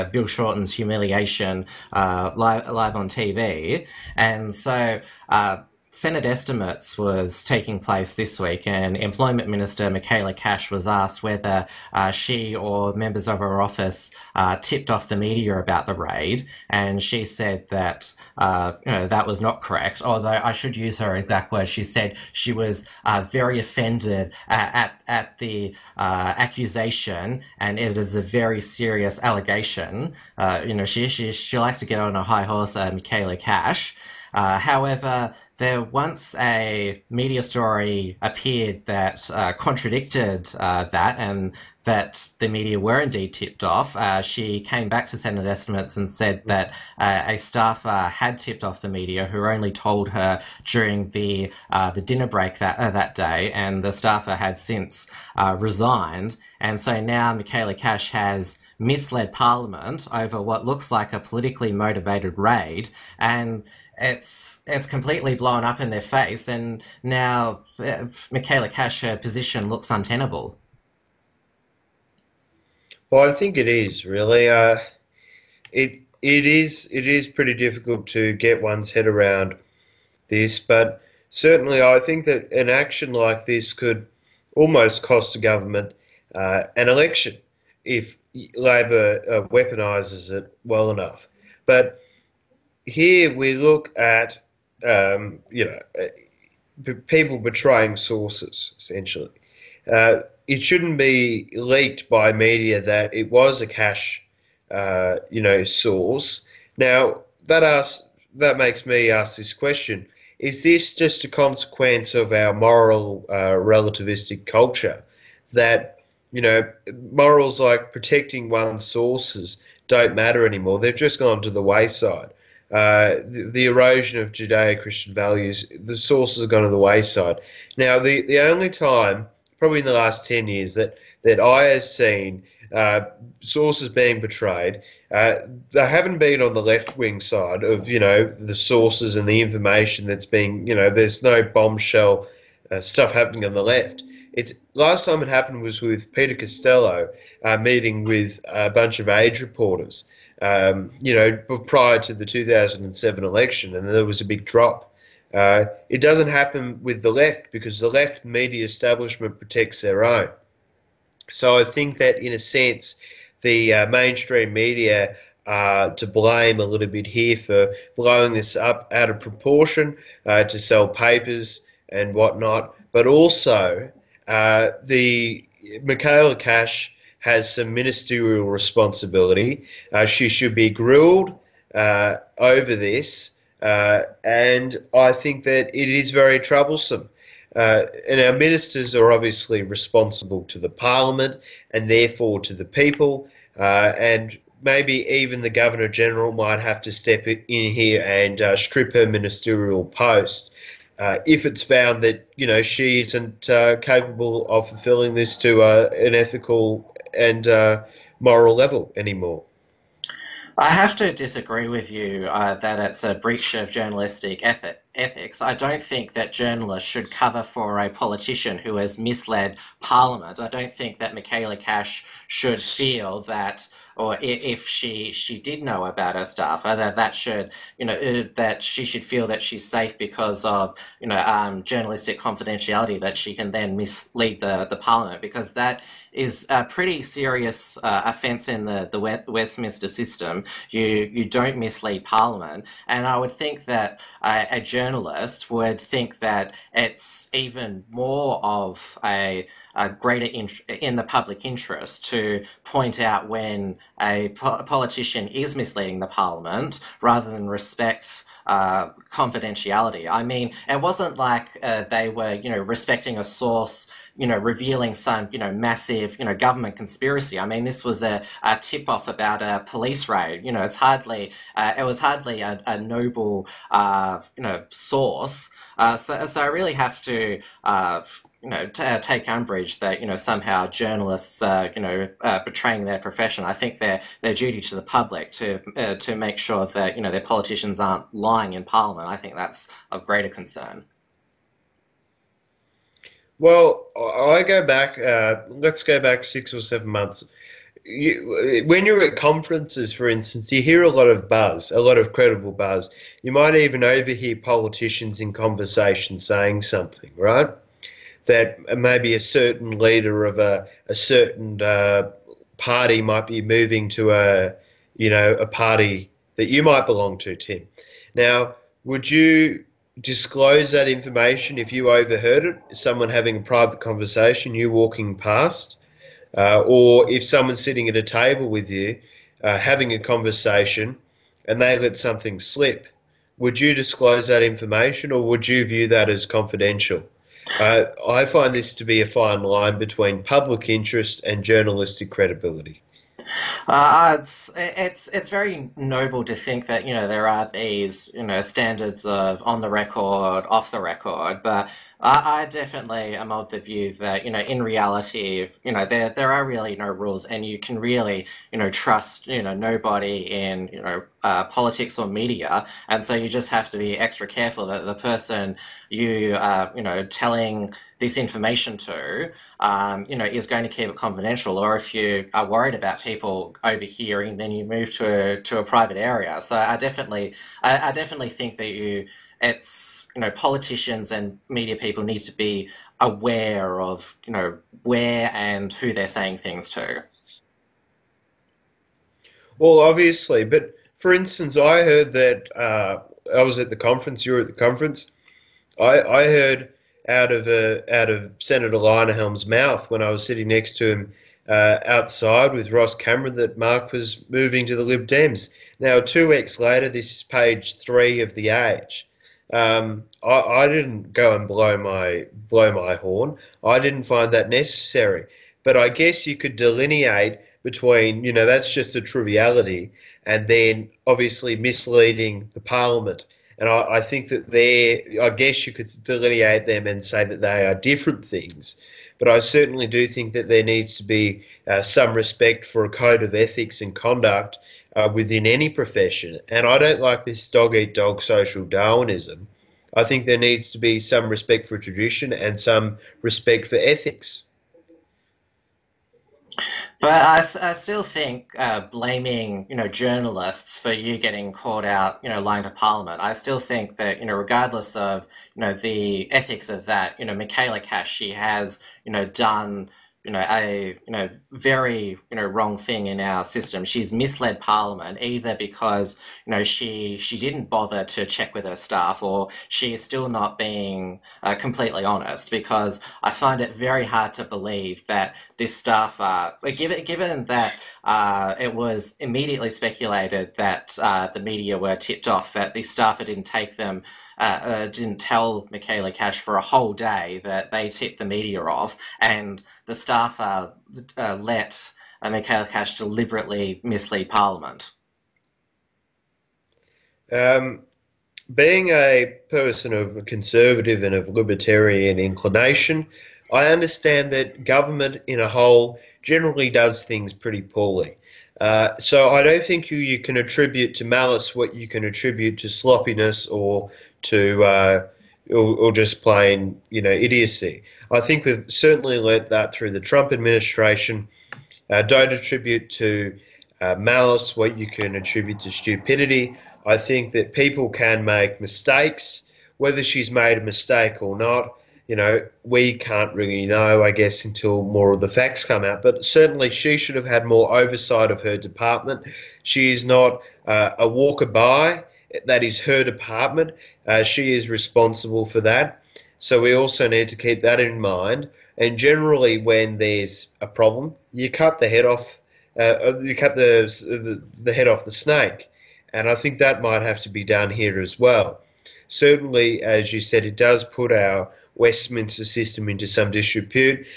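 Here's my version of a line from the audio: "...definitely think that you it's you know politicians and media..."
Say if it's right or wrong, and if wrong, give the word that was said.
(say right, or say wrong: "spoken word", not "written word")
right.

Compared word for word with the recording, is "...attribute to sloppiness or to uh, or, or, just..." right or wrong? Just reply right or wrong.
right.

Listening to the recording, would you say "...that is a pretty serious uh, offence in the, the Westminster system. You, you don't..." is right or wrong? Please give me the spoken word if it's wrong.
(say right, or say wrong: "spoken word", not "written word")
right.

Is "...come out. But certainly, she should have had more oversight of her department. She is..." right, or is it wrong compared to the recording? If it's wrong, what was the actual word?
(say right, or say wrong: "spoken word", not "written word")
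right.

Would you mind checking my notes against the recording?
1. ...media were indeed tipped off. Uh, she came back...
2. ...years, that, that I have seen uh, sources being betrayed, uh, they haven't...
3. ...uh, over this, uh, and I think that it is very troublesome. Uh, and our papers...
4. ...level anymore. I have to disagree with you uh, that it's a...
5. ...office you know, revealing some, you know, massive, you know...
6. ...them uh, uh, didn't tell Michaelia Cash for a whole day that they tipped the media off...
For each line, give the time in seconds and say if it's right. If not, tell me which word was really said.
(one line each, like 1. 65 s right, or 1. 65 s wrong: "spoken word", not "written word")
1. 42 s right
2. 130 s right
3. 181 s wrong: "ministers", not "papers"
4. 208 s right
5. 263 s wrong: "source", not "office"
6. 483 s right.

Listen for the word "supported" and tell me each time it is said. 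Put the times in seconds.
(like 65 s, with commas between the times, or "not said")
not said.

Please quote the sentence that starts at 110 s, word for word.
Is this just a consequence of our moral uh, relativistic culture that you know, morals like protecting one's sources don't matter anymore.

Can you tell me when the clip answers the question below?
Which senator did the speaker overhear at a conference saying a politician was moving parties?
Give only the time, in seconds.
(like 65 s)
398 s.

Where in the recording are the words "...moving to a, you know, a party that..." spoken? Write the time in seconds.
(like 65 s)
313 s.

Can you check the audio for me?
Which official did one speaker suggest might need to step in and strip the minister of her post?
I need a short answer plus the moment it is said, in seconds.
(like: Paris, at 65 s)
governor general, at 195 s.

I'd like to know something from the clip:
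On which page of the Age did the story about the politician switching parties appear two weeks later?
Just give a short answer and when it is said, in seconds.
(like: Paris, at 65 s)
page 3, at 407 s.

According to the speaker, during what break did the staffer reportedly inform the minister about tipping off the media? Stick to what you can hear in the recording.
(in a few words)
dinner break.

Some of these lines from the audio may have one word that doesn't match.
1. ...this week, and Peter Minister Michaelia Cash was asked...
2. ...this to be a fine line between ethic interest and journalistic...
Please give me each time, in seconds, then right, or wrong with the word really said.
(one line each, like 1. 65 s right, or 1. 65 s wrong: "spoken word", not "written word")
1. 8 s wrong: "Employment", not "Peter"
2. 338 s wrong: "public", not "ethic".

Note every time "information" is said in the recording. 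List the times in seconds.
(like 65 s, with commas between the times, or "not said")
139 s, 320 s, 334 s, 368 s.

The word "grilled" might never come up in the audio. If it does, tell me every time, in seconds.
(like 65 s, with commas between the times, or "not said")
180 s.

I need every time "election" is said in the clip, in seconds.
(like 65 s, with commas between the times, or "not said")
86 s, 153 s.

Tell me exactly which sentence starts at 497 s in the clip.
Um, being a person of conservative and of libertarian inclination, I understand that government in a whole generally does things pretty poorly.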